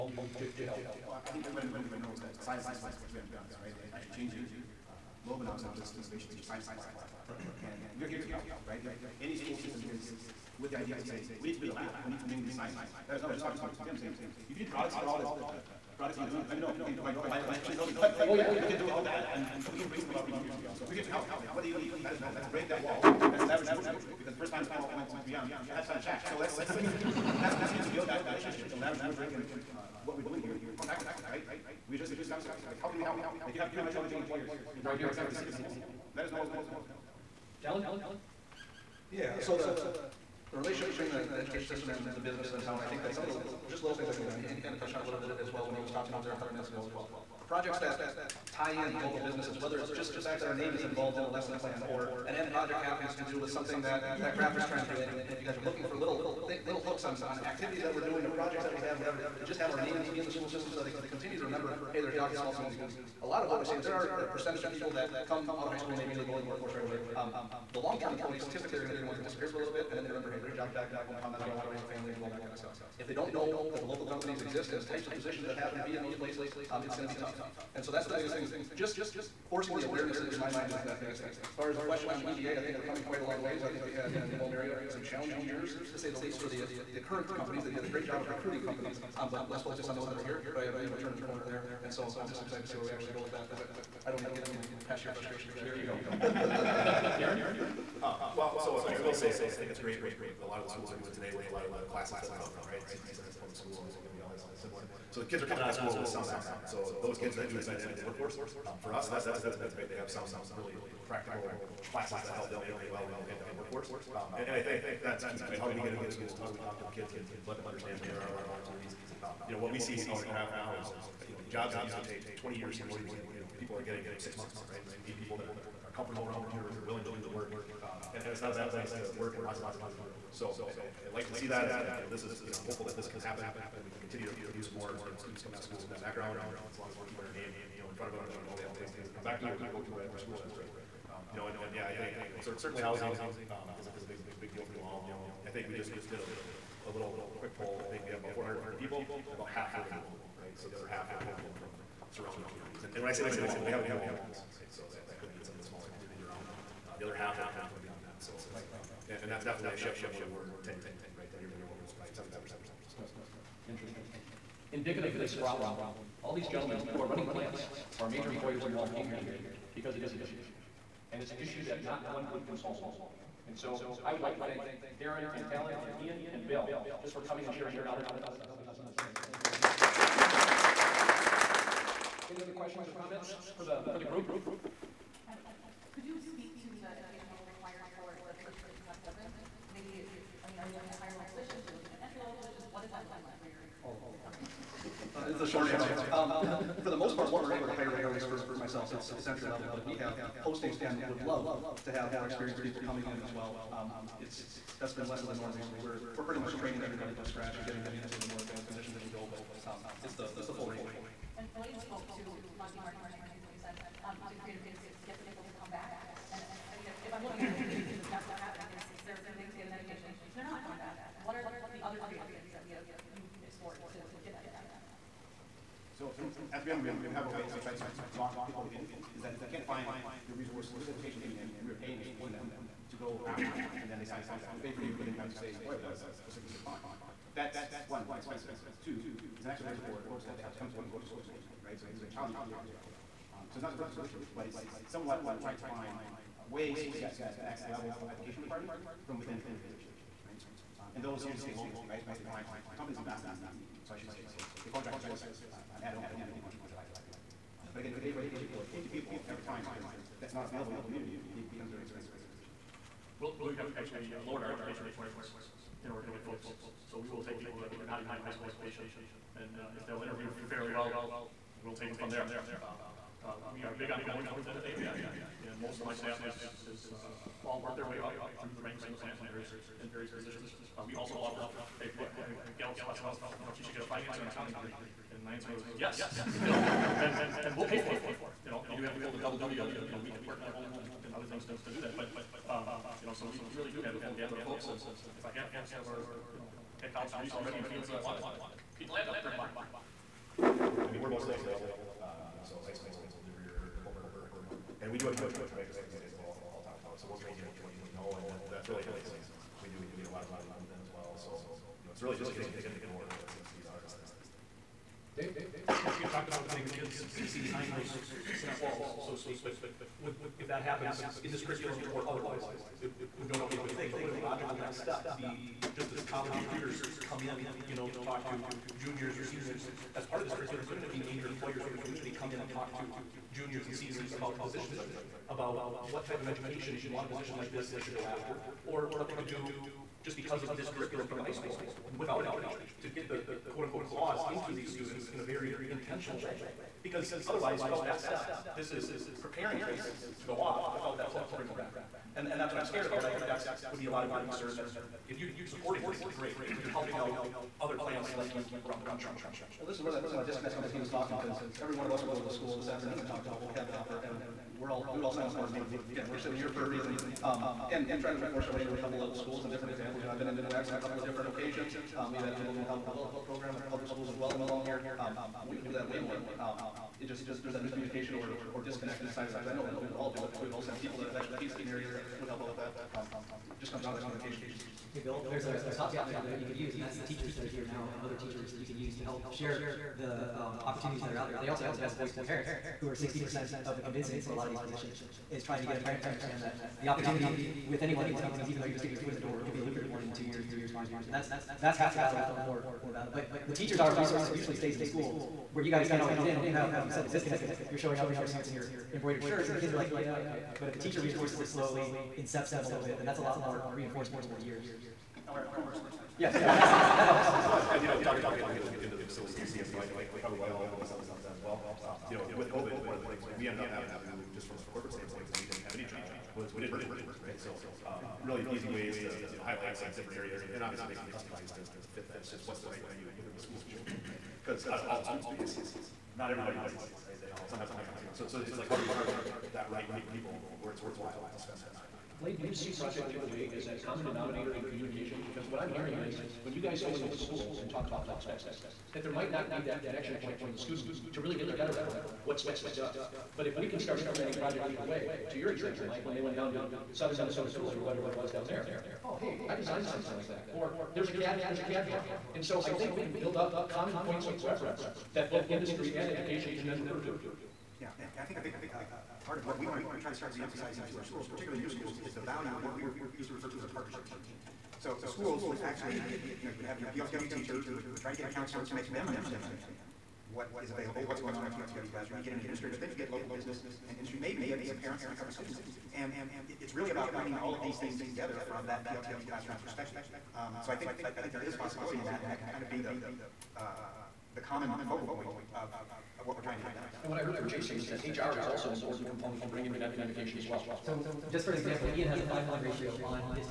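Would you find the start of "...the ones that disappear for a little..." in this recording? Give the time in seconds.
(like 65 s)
68 s.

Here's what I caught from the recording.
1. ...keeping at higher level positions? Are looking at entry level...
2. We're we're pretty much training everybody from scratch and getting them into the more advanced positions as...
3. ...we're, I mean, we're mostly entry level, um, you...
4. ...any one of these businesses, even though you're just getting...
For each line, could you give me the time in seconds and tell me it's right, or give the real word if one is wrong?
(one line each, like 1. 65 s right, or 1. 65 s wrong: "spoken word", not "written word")
1. 190 s wrong: "looking", not "keeping"
2. 205 s right
3. 300 s right
4. 397 s wrong: "companies", not "businesses".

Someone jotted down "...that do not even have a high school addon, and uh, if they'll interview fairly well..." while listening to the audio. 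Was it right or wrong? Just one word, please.
wrong.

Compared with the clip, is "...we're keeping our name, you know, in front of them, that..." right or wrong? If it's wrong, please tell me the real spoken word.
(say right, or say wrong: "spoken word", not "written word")
right.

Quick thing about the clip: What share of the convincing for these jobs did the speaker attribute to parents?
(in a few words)
60%.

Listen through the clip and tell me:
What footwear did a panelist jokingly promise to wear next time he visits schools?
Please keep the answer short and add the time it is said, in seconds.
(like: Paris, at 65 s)
Converse, at 415 s.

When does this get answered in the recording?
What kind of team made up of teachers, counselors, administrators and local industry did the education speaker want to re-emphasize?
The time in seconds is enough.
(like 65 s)
473 s.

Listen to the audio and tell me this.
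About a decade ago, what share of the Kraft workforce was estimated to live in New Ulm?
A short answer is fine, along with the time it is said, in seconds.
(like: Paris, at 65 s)
75%, at 162 s.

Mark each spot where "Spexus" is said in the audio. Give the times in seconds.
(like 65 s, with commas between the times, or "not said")
448 s, 452 s.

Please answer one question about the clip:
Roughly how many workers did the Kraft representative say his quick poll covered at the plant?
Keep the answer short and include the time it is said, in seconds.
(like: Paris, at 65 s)
450, at 148 s.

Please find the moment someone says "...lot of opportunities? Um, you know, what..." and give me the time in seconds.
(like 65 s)
118 s.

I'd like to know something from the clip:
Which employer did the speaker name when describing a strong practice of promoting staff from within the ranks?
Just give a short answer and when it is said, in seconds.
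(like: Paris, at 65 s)
AMPI, at 274 s.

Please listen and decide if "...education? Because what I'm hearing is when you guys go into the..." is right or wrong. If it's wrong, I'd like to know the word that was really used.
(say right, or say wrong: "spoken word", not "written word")
wrong: "communication", not "education".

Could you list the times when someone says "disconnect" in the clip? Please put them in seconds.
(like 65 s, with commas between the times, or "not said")
360 s, 378 s, 407 s.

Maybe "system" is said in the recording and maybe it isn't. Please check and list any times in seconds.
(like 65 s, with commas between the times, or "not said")
9 s, 41 s, 60 s.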